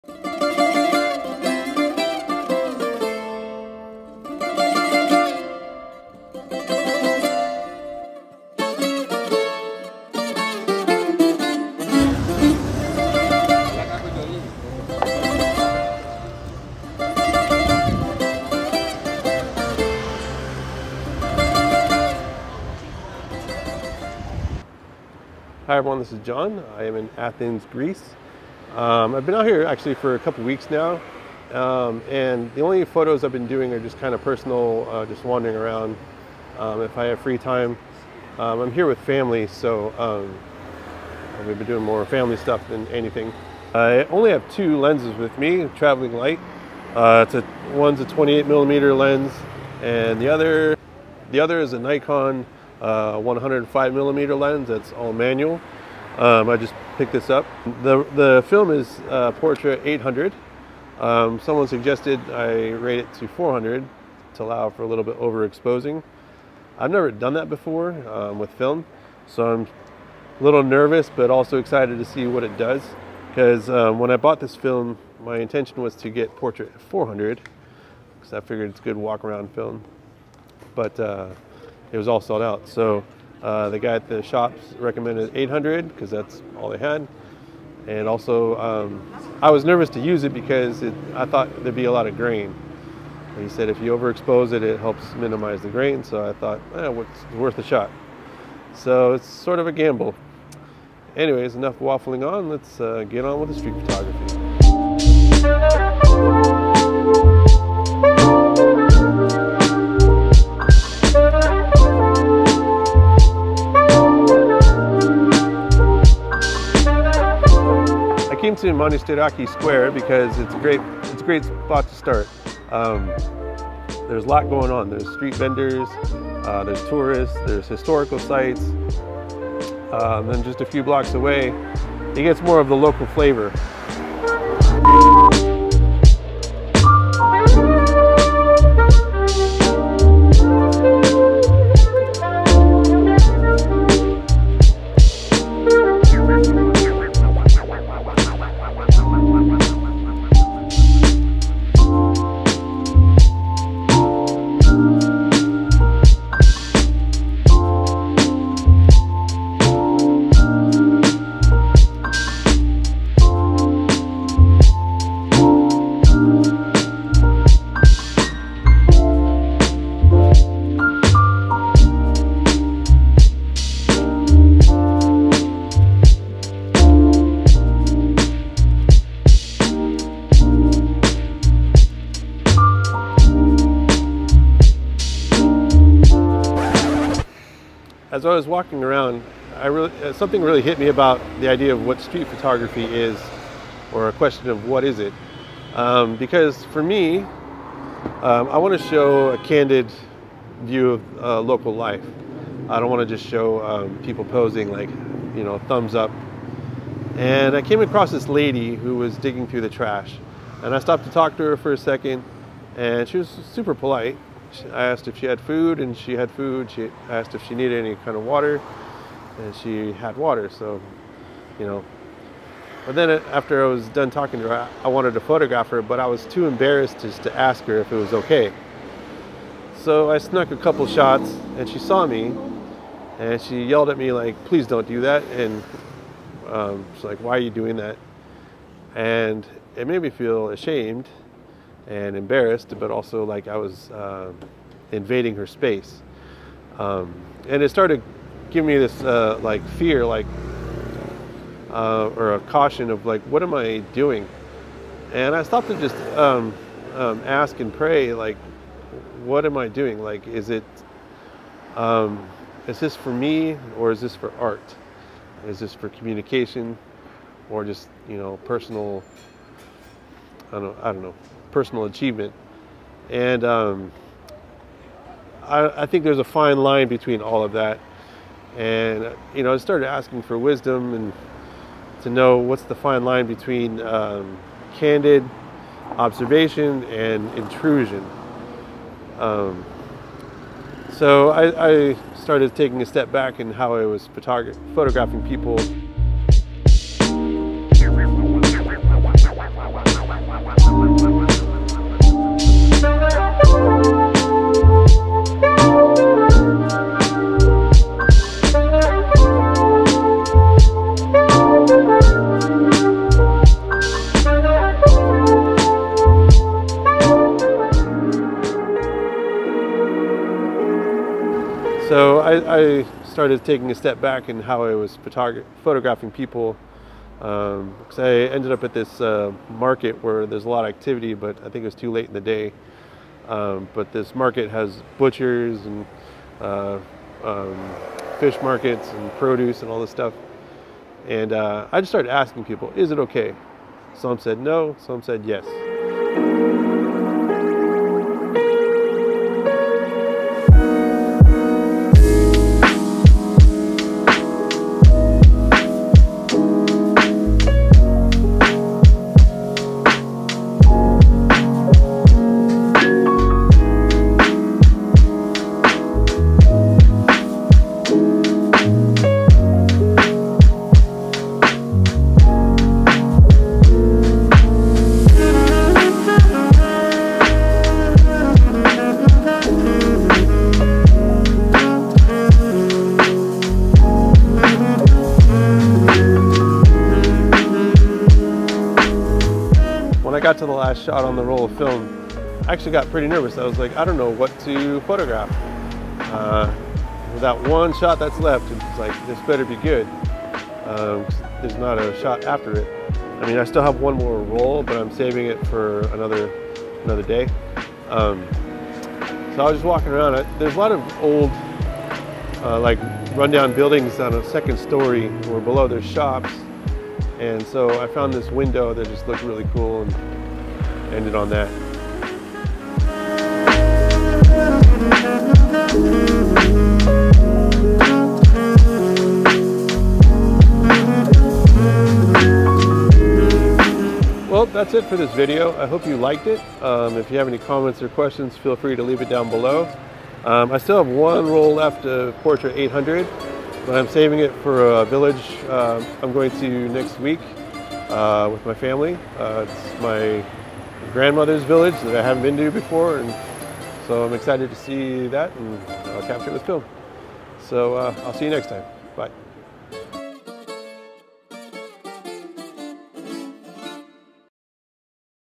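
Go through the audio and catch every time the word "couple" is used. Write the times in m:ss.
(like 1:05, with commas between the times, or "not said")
0:30, 3:50.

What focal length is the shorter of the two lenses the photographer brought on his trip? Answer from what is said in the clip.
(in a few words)
28mm.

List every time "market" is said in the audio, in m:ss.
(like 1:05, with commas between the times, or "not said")
5:29, 5:34, 5:38.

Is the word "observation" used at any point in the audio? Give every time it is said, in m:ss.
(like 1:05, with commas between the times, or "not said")
4:45.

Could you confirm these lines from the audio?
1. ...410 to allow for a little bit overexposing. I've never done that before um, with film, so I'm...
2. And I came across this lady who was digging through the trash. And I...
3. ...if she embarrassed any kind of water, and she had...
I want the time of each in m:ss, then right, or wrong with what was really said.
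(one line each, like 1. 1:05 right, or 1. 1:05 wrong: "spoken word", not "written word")
1. 1:03 wrong: "400", not "410"
2. 3:27 right
3. 3:37 wrong: "needed", not "embarrassed".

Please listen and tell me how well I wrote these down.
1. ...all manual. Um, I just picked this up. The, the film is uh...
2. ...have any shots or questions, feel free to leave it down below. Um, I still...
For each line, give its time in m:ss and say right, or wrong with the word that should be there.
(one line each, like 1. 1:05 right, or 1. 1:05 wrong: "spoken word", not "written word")
1. 0:54 right
2. 7:17 wrong: "comments", not "shots".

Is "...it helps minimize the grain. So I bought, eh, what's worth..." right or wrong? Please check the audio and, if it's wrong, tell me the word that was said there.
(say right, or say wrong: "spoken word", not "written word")
wrong: "thought", not "bought".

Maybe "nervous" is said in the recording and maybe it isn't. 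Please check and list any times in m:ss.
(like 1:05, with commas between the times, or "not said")
1:10, 1:29, 6:33.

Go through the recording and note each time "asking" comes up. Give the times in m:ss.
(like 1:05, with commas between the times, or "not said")
4:39, 5:42.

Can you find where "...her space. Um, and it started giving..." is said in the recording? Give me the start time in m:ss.
4:05.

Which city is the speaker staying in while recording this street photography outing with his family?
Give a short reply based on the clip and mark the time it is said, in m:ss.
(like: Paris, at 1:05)
Athens, at 0:27.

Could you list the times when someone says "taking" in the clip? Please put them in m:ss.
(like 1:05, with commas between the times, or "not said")
4:52, 5:23.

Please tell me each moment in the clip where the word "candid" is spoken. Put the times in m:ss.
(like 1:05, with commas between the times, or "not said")
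3:19, 4:44.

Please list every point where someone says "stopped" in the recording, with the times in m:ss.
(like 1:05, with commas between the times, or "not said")
3:30, 4:15.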